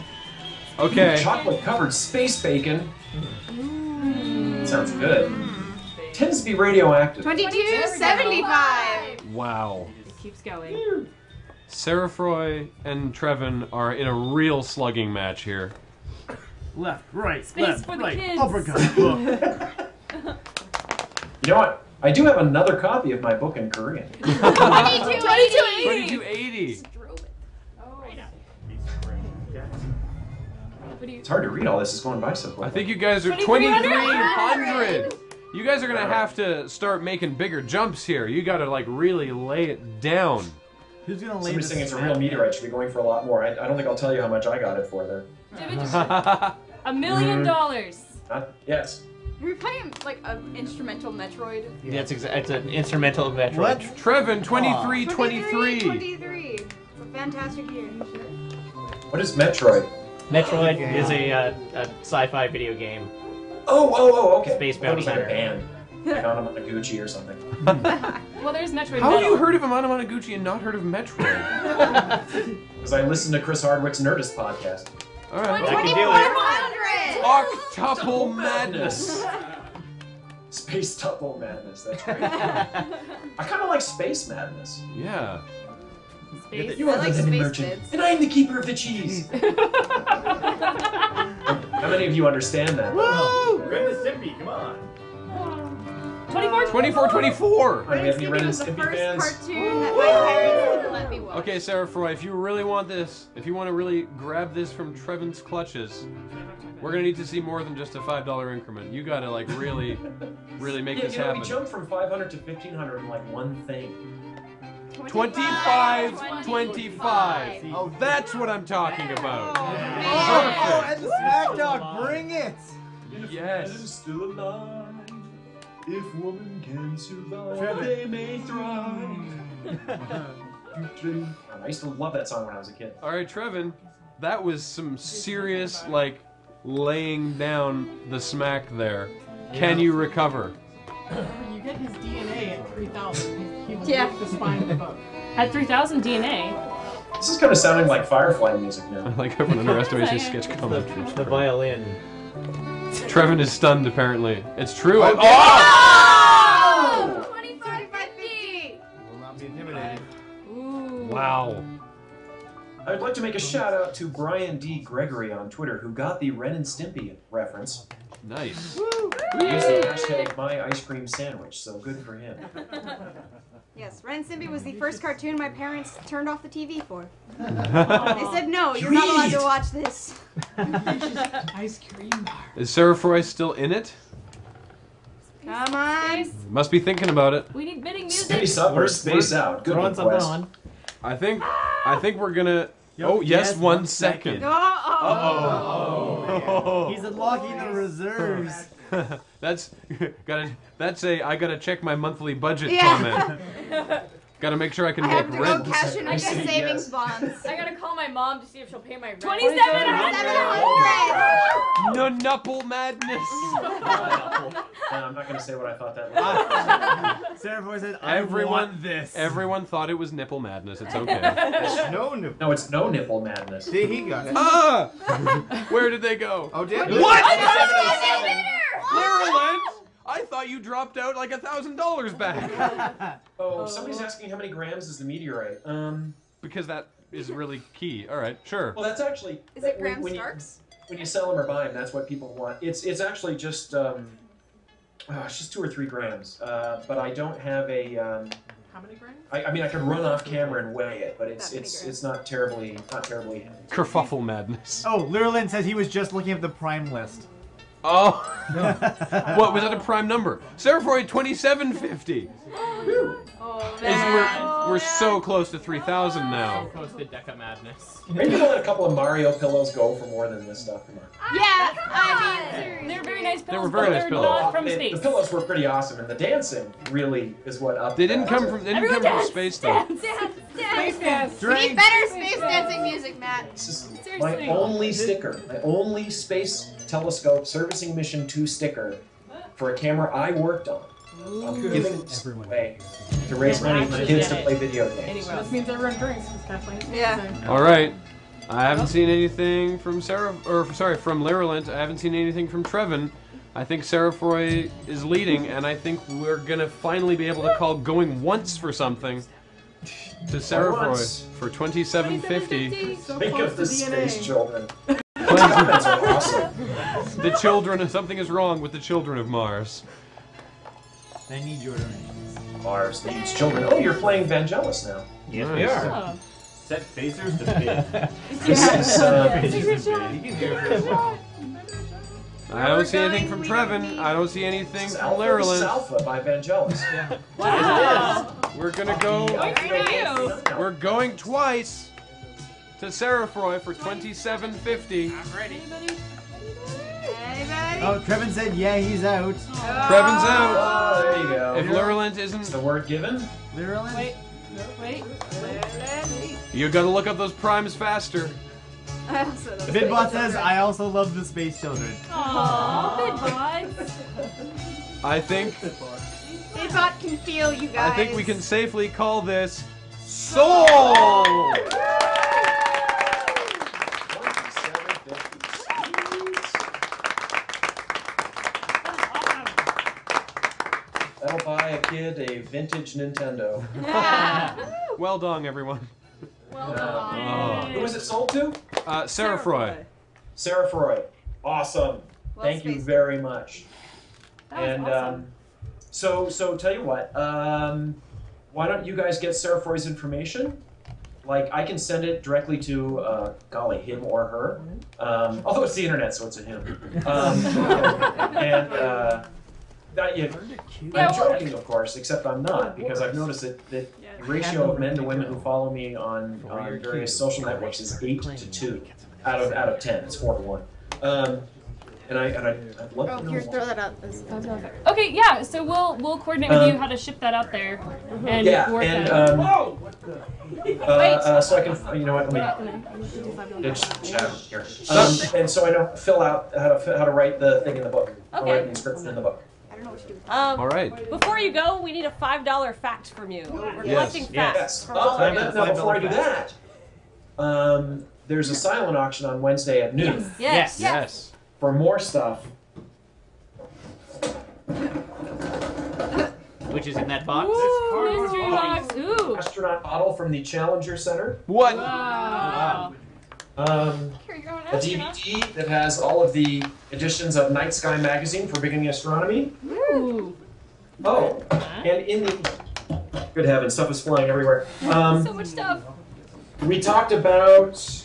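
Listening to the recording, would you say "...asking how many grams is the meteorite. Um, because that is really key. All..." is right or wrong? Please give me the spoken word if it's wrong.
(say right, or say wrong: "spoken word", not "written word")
right.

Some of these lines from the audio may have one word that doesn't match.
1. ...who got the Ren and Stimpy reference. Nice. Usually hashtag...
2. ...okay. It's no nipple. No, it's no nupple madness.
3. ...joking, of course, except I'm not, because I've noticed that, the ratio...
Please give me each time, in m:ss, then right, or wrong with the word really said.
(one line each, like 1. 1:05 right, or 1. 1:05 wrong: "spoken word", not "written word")
1. 2:45 right
2. 3:40 wrong: "nipple", not "nupple"
3. 6:51 right.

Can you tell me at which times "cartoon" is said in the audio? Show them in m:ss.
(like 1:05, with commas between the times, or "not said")
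2:55.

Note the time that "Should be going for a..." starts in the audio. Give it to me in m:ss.
0:42.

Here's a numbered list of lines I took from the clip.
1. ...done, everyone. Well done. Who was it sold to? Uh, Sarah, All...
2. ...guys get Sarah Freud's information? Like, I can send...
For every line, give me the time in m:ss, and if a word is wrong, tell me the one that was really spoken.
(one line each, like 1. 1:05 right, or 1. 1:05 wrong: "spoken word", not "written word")
1. 6:25 wrong: "Sarah", not "All"
2. 6:38 right.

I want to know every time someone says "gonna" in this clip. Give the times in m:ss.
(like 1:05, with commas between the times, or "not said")
0:35, 0:41, 1:46, 3:12, 3:35, 5:06, 5:38.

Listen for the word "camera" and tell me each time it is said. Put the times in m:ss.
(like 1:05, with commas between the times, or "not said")
4:10, 4:49.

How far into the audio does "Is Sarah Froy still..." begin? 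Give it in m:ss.
3:02.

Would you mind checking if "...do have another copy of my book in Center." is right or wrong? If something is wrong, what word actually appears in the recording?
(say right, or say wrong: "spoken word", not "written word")
wrong: "Korean", not "Center".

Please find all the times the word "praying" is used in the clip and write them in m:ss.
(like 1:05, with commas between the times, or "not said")
not said.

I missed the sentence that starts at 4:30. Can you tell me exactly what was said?
Yeah, yeah I mean, they're very nice pillows.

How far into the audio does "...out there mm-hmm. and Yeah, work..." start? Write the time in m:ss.
7:07.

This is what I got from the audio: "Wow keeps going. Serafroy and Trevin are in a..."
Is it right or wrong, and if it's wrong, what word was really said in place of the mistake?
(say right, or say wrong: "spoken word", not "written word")
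right.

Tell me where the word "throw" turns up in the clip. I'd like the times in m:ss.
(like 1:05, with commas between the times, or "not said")
7:03.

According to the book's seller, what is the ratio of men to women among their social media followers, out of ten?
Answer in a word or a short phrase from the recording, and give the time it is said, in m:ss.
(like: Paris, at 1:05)
8 to 2, at 6:58.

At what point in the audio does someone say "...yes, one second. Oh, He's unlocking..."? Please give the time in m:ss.
3:13.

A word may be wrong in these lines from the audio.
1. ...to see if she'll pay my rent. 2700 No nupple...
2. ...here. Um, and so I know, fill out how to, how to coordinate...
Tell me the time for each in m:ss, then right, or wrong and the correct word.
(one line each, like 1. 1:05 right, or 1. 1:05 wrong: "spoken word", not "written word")
1. 3:28 right
2. 7:14 wrong: "write", not "coordinate".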